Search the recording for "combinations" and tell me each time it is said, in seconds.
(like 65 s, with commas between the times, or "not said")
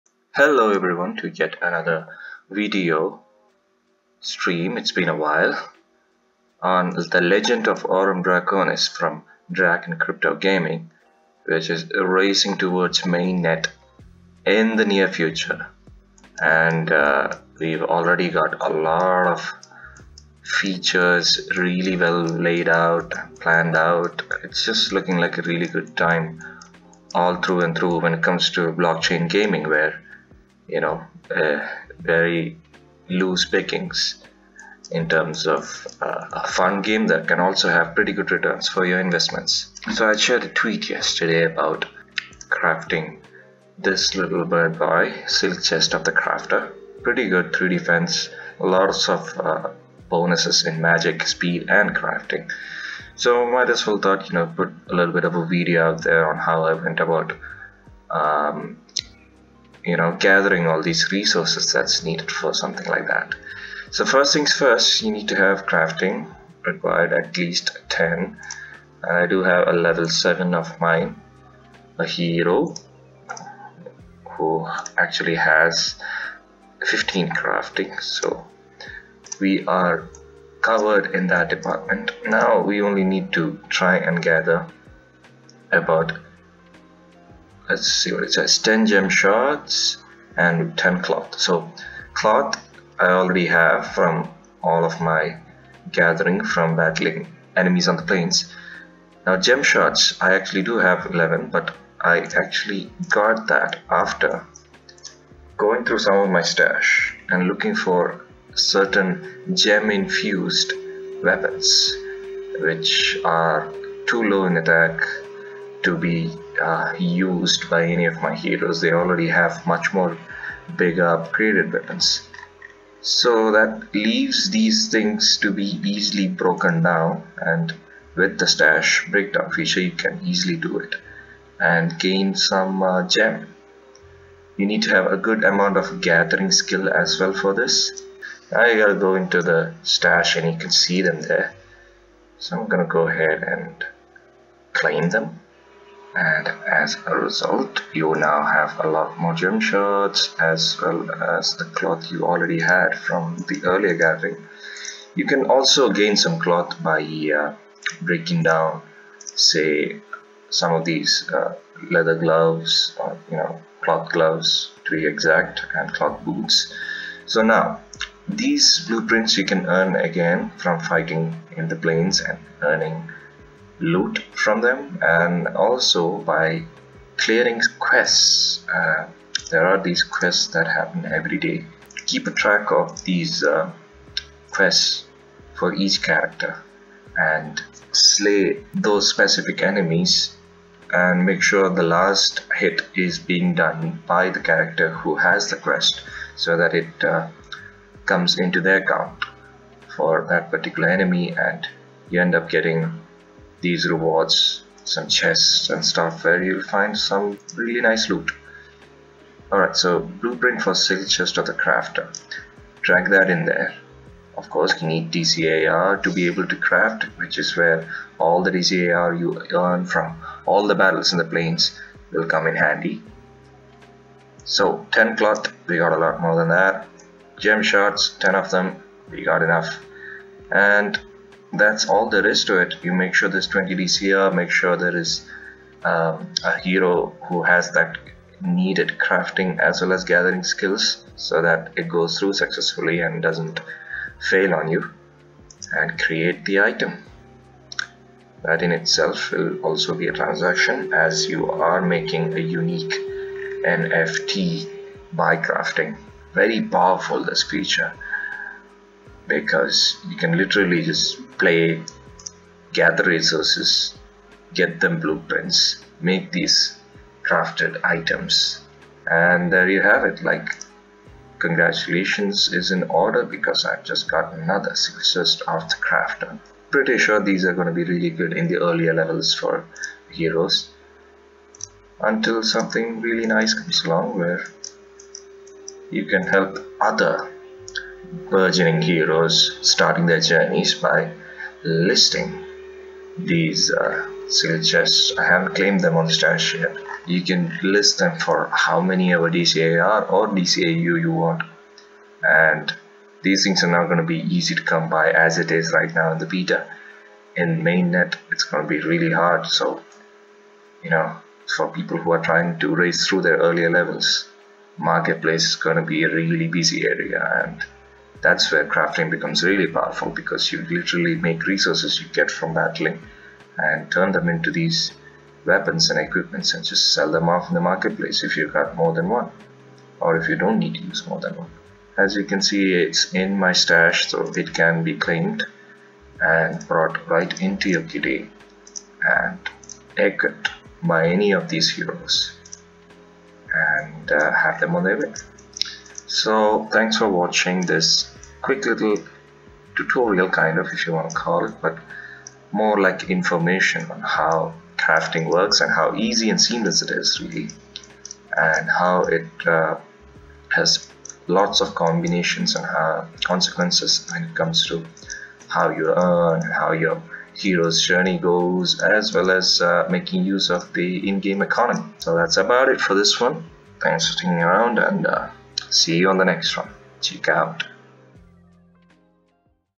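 361 s.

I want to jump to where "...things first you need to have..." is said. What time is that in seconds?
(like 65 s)
64 s.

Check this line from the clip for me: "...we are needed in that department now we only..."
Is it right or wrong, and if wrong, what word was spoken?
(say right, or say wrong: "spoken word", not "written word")
wrong: "covered", not "needed".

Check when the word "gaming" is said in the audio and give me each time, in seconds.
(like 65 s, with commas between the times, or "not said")
10 s, 29 s.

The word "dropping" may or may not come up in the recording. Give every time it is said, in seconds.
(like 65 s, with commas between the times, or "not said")
not said.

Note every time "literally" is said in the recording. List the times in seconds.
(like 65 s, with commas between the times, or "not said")
260 s, 320 s.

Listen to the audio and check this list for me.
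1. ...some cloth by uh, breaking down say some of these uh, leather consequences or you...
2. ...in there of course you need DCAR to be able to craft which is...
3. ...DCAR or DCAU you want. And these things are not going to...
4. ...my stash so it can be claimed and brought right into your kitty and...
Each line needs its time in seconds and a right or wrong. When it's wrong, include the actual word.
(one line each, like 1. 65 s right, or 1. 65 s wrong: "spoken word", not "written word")
1. 156 s wrong: "gloves", not "consequences"
2. 213 s right
3. 299 s right
4. 333 s right.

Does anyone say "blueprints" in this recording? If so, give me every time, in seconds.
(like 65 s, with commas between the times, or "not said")
168 s, 209 s, 264 s.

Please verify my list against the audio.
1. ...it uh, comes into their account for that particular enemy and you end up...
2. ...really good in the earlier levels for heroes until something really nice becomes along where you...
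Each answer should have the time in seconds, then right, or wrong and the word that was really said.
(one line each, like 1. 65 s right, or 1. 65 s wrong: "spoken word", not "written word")
1. 196 s right
2. 277 s wrong: "comes", not "becomes".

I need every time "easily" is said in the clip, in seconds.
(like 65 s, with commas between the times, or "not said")
125 s, 130 s.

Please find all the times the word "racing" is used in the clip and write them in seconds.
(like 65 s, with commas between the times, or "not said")
11 s.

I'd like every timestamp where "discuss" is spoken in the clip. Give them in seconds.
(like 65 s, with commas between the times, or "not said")
not said.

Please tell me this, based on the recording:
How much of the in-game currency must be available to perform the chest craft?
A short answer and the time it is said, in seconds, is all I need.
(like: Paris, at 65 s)
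20 DCAR, at 233 s.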